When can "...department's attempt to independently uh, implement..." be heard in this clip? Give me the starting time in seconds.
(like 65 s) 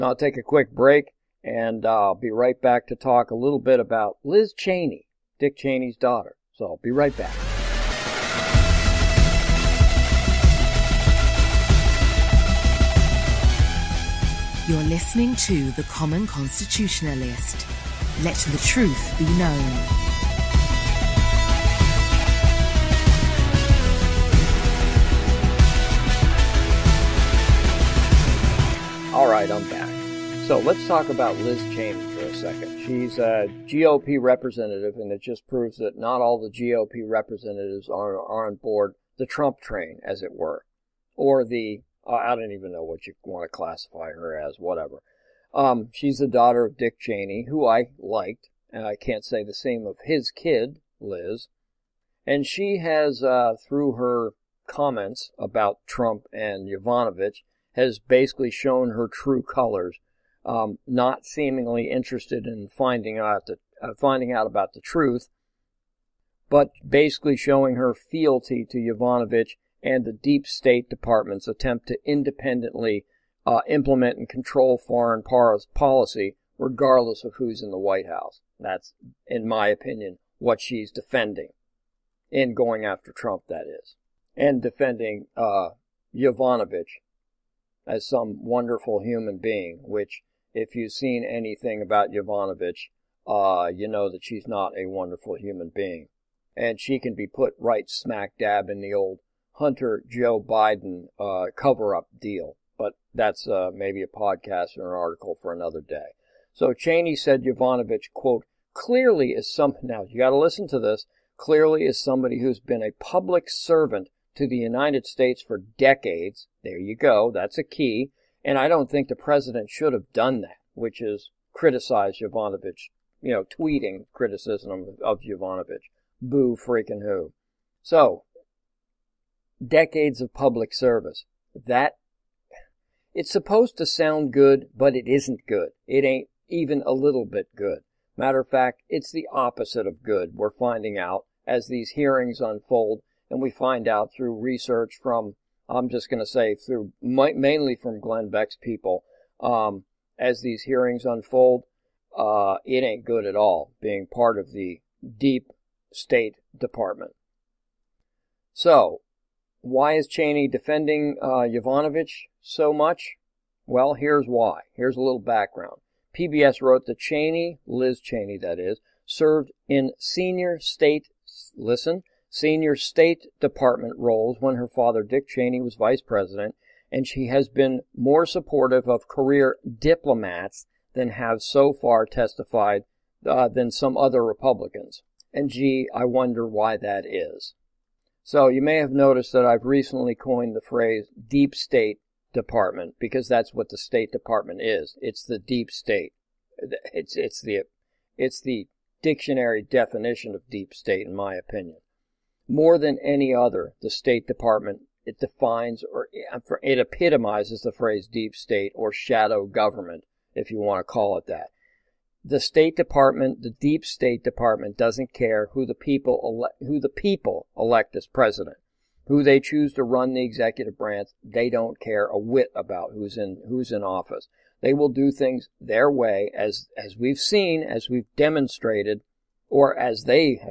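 70 s.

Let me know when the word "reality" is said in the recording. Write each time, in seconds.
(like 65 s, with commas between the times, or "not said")
not said.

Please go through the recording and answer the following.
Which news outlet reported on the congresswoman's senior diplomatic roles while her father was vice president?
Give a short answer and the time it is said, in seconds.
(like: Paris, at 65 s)
PBS, at 166 s.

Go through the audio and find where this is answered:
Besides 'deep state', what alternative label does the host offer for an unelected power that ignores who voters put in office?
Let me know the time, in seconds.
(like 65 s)
208 s.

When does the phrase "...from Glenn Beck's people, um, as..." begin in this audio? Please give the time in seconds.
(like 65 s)
147 s.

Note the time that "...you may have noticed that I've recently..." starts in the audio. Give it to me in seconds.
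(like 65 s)
188 s.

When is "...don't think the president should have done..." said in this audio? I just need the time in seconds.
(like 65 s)
118 s.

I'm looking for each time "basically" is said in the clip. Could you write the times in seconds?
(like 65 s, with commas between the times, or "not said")
57 s, 66 s.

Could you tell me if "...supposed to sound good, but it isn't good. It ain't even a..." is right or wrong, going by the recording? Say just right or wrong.
right.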